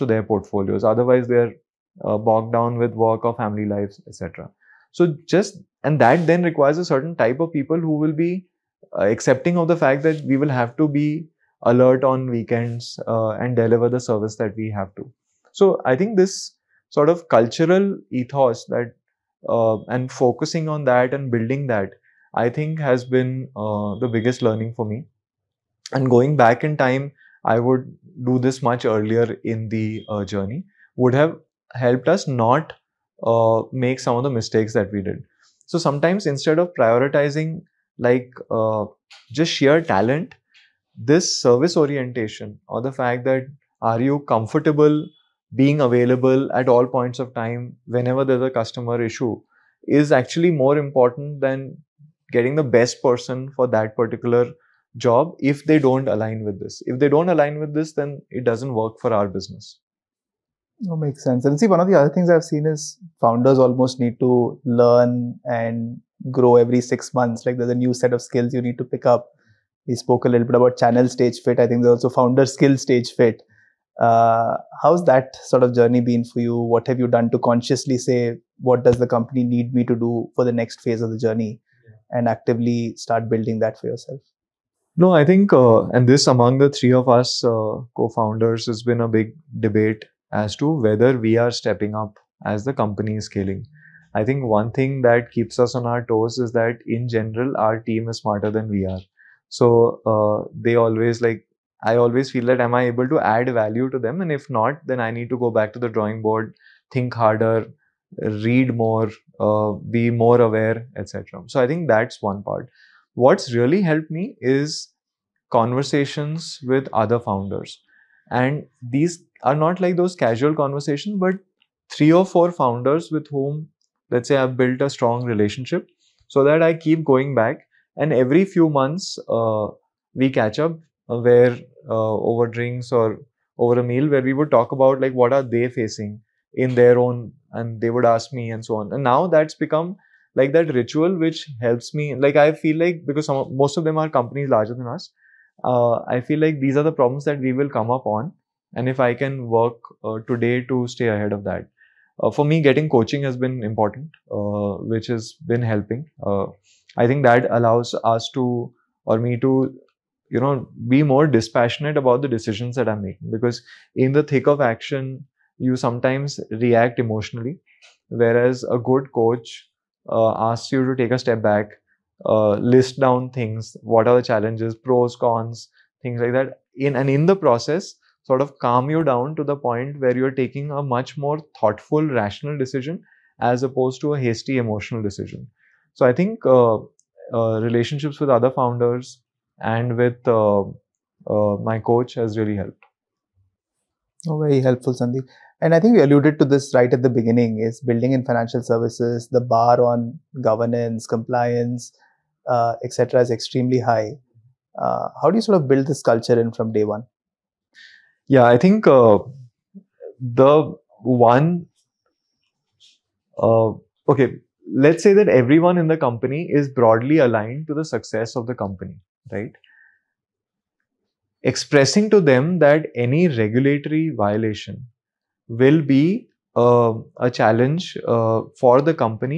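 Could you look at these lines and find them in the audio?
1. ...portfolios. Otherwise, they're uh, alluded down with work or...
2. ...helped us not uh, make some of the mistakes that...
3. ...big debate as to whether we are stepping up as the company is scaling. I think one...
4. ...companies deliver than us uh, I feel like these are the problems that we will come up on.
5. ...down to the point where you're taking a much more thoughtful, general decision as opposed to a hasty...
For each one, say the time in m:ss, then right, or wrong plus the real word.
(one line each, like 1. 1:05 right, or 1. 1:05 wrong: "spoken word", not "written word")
1. 0:00 wrong: "bogged", not "alluded"
2. 0:31 right
3. 1:29 right
4. 2:24 wrong: "larger", not "deliver"
5. 2:59 wrong: "rational", not "general".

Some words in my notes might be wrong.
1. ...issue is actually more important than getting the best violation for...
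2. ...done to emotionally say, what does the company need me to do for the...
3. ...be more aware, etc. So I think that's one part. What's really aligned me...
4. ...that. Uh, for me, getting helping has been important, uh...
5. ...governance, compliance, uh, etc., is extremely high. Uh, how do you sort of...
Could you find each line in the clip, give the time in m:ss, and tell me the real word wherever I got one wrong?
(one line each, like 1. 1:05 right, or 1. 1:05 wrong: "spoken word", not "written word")
1. 0:49 wrong: "person", not "violation"
2. 1:17 wrong: "consciously", not "emotionally"
3. 1:49 wrong: "helped", not "aligned"
4. 2:31 wrong: "coaching", not "helping"
5. 3:20 right.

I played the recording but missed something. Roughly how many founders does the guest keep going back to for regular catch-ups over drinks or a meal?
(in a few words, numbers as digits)
3 or 4.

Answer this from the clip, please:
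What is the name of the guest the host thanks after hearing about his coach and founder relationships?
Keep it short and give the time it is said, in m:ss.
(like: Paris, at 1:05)
Sandeep, at 3:14.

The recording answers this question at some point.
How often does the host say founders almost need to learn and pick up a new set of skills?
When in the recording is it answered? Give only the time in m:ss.
1:06.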